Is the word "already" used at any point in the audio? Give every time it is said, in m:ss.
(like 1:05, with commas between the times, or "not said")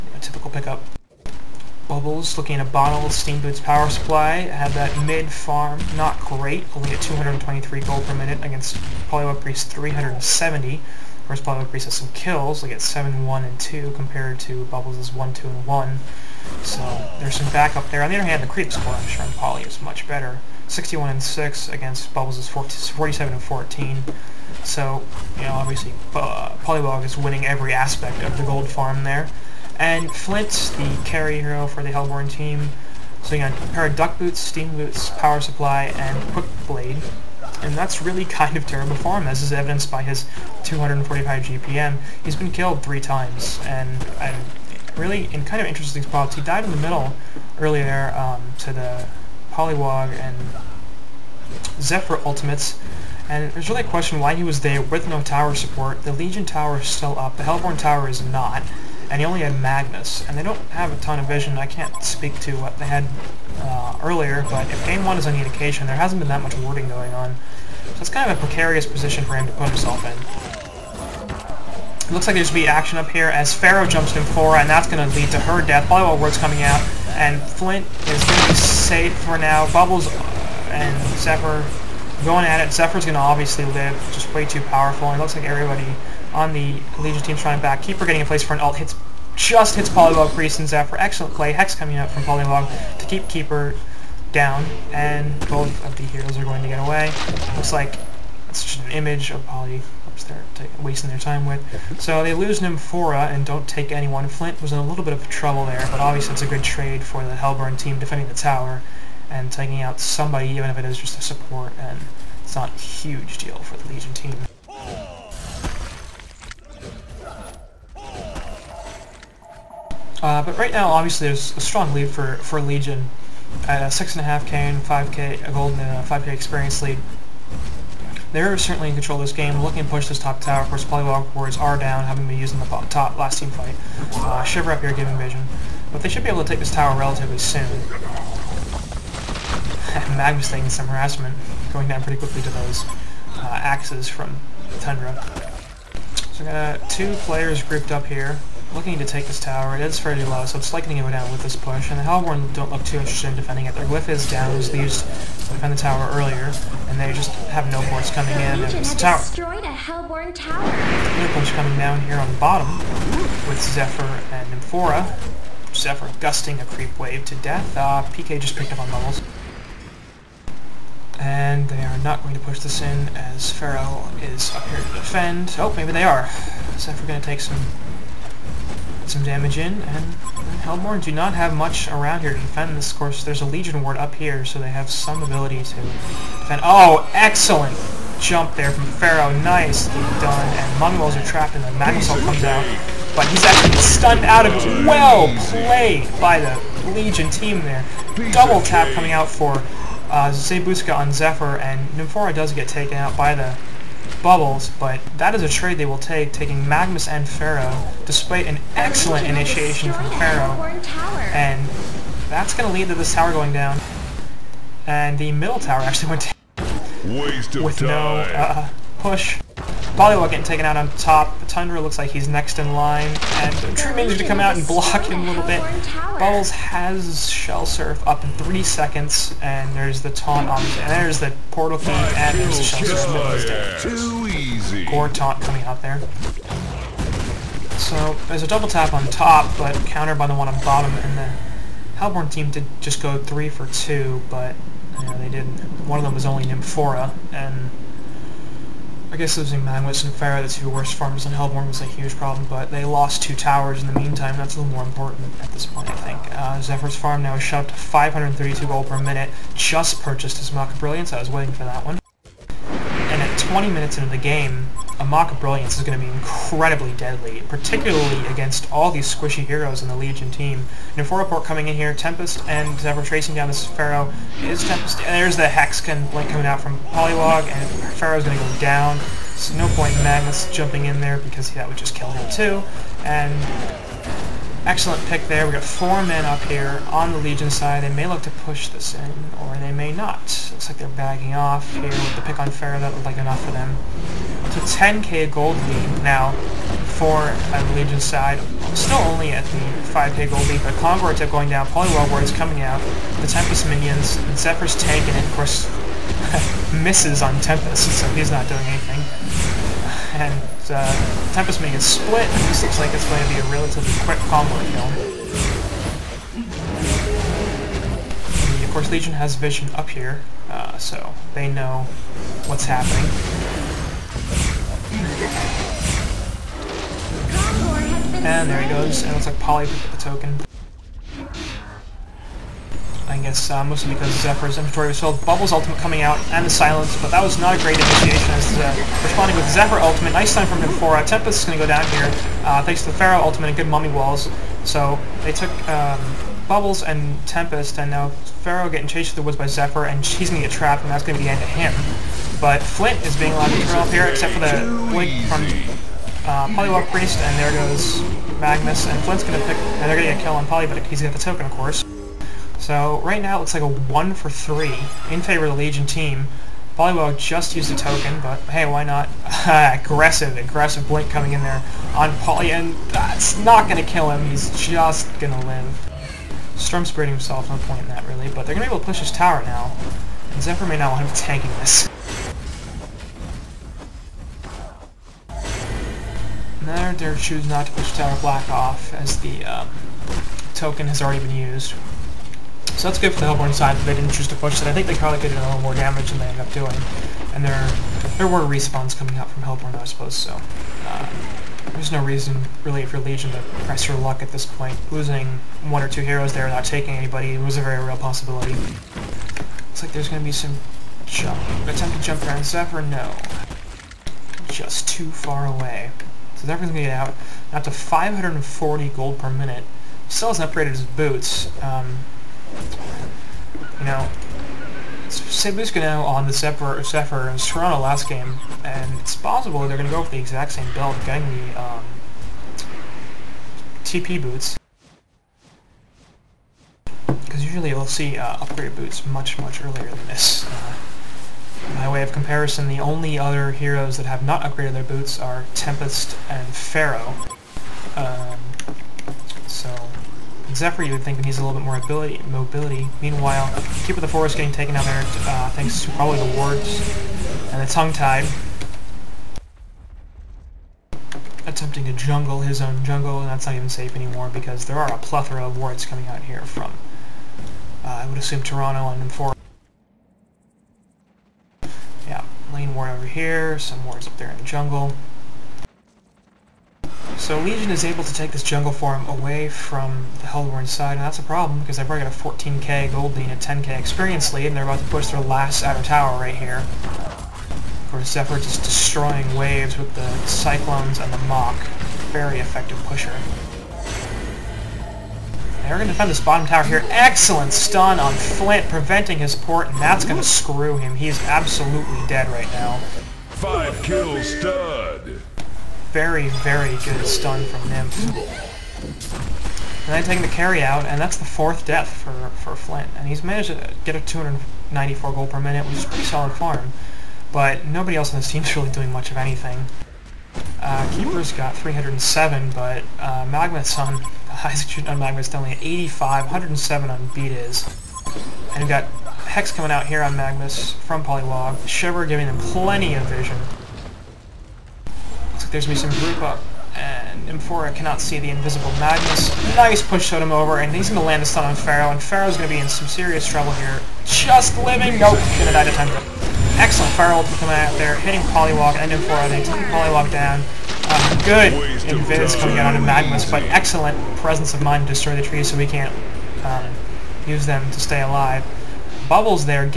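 6:31, 8:01.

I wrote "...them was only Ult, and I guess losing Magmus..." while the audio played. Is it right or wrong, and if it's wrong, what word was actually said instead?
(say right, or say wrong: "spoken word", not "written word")
wrong: "Nymphora", not "Ult".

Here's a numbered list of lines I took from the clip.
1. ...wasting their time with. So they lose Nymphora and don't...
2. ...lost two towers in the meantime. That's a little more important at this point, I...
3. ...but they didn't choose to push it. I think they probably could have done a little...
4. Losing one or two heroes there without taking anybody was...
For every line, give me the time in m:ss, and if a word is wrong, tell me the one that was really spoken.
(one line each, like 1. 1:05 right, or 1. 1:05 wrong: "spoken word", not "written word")
1. 1:40 right
2. 4:12 right
3. 6:33 right
4. 6:44 right.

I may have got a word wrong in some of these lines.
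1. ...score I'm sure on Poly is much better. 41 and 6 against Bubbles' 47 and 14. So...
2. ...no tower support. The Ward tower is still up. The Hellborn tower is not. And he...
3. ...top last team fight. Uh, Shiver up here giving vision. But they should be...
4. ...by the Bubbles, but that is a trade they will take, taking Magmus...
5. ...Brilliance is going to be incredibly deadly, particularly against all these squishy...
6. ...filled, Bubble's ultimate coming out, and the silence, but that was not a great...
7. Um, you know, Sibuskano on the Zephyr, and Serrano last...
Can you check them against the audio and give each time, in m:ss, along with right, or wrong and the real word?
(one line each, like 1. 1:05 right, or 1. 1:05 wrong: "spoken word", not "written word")
1. 0:18 wrong: "61", not "41"
2. 0:55 wrong: "Legion", not "Ward"
3. 2:12 right
4. 3:23 right
5. 4:25 right
6. 5:34 right
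7. 7:01 right.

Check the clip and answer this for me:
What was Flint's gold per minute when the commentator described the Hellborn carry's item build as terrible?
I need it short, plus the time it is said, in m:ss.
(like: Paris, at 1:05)
245, at 0:40.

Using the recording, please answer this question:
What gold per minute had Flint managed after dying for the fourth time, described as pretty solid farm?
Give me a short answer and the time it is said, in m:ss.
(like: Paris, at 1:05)
294, at 8:34.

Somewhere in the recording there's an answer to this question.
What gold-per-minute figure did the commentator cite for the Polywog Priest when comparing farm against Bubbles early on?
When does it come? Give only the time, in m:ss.
0:09.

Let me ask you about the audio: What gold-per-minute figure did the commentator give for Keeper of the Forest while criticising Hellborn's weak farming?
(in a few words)
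307.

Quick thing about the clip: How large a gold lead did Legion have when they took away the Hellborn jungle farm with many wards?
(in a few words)
14k.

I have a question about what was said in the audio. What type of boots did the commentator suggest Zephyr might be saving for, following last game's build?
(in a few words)
TP boots.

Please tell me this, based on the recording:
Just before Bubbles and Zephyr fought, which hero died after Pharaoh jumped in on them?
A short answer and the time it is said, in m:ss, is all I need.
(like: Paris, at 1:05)
Flora, at 1:14.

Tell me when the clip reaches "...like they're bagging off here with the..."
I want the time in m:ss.
4:50.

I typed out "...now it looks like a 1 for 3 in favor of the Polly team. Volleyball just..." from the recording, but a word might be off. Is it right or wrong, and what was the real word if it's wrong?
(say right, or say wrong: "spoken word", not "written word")
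wrong: "Legion", not "Polly".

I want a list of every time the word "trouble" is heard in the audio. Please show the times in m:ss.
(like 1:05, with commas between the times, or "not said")
1:45, 9:03.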